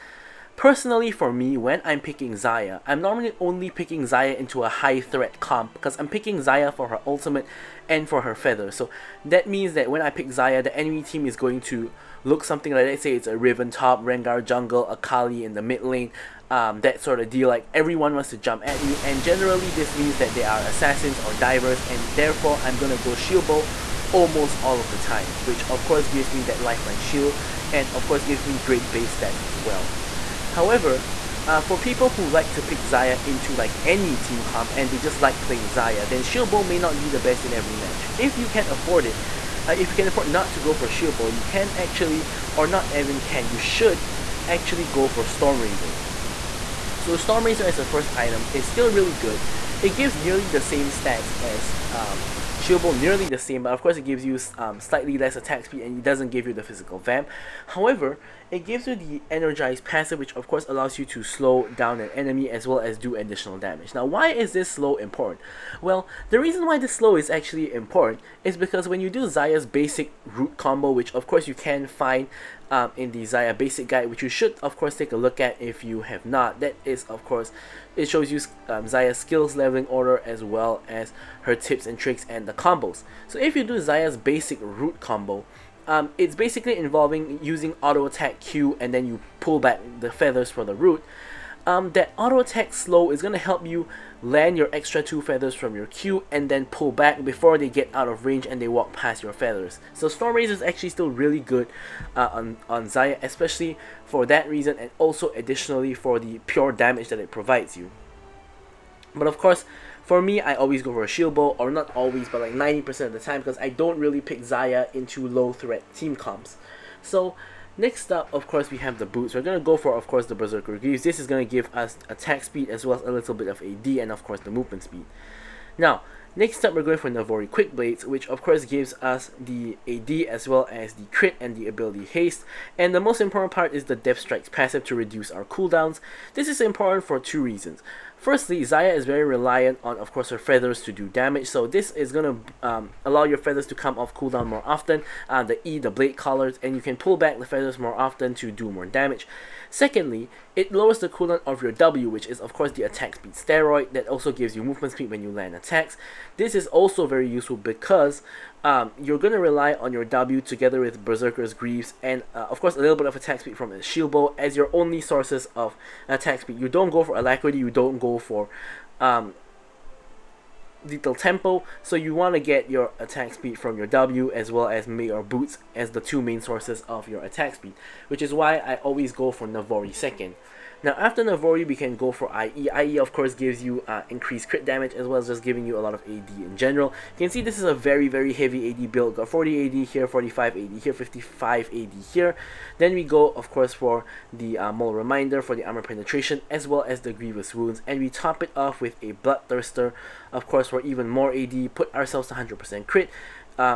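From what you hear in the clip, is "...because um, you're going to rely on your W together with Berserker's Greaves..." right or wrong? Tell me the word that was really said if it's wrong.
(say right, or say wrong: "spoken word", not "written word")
right.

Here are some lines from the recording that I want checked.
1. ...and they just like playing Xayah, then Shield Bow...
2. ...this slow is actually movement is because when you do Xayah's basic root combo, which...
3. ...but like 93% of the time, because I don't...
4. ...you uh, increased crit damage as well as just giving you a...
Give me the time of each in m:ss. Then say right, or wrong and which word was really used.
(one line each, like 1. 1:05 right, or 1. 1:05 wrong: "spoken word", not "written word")
1. 0:34 right
2. 1:06 wrong: "important", not "movement"
3. 1:52 wrong: "90", not "93"
4. 3:03 right.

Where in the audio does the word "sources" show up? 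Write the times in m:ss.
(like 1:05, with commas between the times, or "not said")
2:44, 2:56.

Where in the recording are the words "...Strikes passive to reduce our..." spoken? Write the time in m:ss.
2:14.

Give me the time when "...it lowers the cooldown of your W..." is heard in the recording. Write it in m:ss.
2:30.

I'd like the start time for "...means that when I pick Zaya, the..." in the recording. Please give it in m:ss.
0:09.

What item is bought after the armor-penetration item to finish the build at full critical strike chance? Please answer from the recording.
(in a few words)
Bloodthirster.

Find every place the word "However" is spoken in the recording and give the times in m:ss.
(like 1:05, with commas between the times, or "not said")
0:30, 0:57.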